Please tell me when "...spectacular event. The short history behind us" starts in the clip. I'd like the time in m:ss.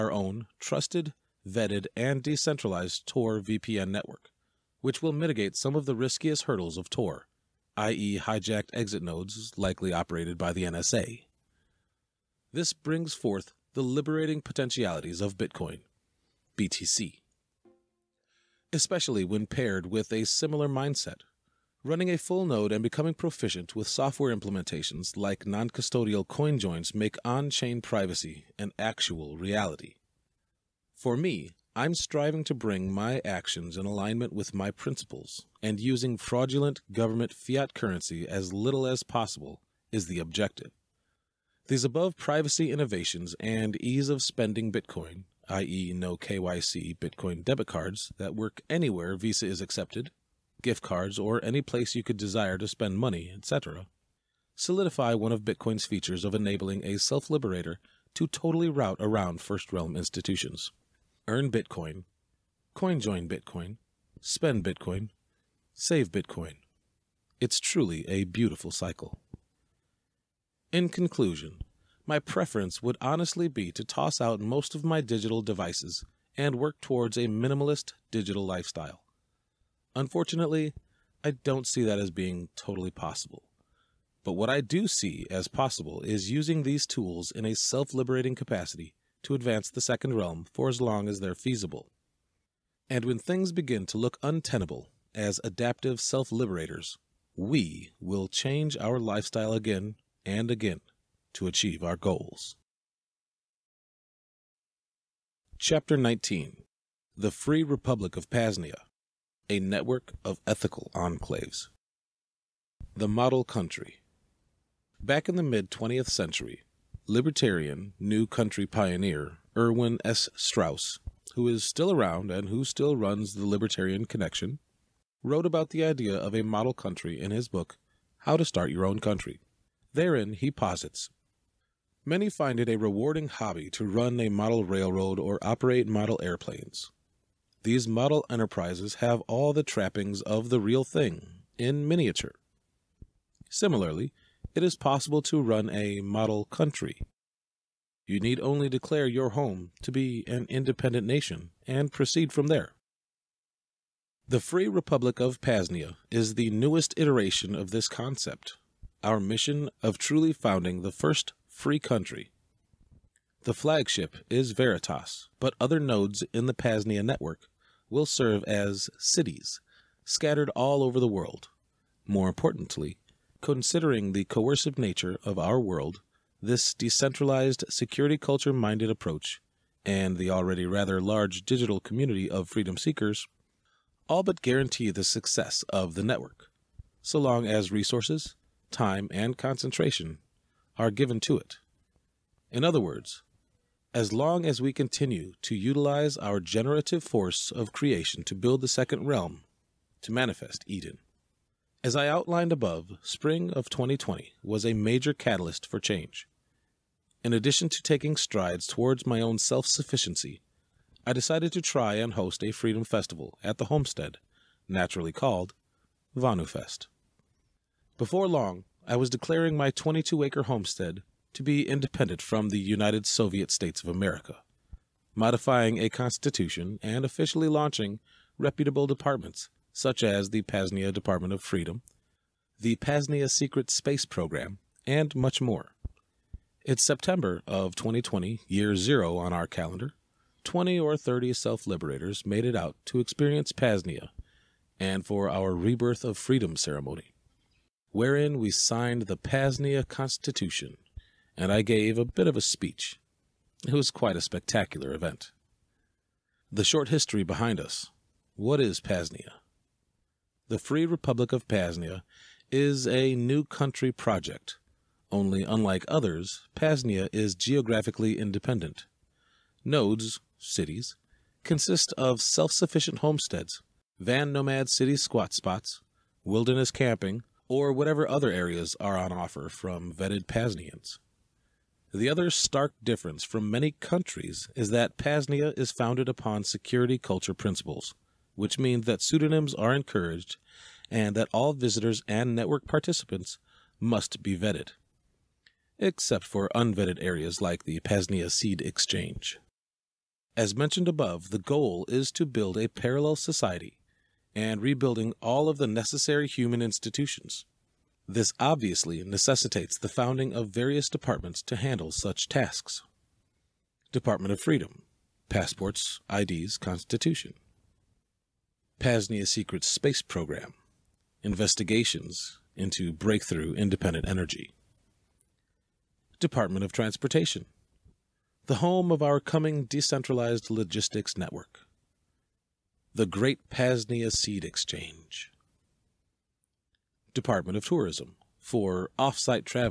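4:14.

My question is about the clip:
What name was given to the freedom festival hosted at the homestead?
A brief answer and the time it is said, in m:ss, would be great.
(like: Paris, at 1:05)
VonuFest, at 3:36.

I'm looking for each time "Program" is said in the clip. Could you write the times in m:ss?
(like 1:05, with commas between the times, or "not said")
3:54, 5:20.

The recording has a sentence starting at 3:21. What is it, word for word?
As I outlined above, spring of 2020 was a major catalyst for change.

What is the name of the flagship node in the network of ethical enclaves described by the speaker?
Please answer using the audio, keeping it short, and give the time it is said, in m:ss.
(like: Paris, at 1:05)
Veritas, at 2:44.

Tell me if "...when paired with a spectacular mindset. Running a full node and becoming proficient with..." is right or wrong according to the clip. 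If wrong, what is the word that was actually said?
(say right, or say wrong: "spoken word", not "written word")
wrong: "similar", not "spectacular".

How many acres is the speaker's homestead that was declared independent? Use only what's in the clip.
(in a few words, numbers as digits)
22.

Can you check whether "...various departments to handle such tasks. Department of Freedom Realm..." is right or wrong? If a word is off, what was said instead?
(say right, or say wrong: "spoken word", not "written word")
wrong: "Passports", not "Realm".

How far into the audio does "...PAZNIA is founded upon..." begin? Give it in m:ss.
4:44.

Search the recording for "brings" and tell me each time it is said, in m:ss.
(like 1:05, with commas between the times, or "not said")
0:12, 0:32.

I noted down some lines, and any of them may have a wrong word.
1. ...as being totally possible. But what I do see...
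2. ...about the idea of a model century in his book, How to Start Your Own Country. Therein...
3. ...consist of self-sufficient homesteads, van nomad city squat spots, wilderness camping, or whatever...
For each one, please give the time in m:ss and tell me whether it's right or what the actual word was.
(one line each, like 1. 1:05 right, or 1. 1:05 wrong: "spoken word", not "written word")
1. 1:21 right
2. 2:05 wrong: "country", not "century"
3. 4:31 right.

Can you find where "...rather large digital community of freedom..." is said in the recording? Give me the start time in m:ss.
3:00.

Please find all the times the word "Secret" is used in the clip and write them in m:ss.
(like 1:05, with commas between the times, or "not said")
3:53, 5:19.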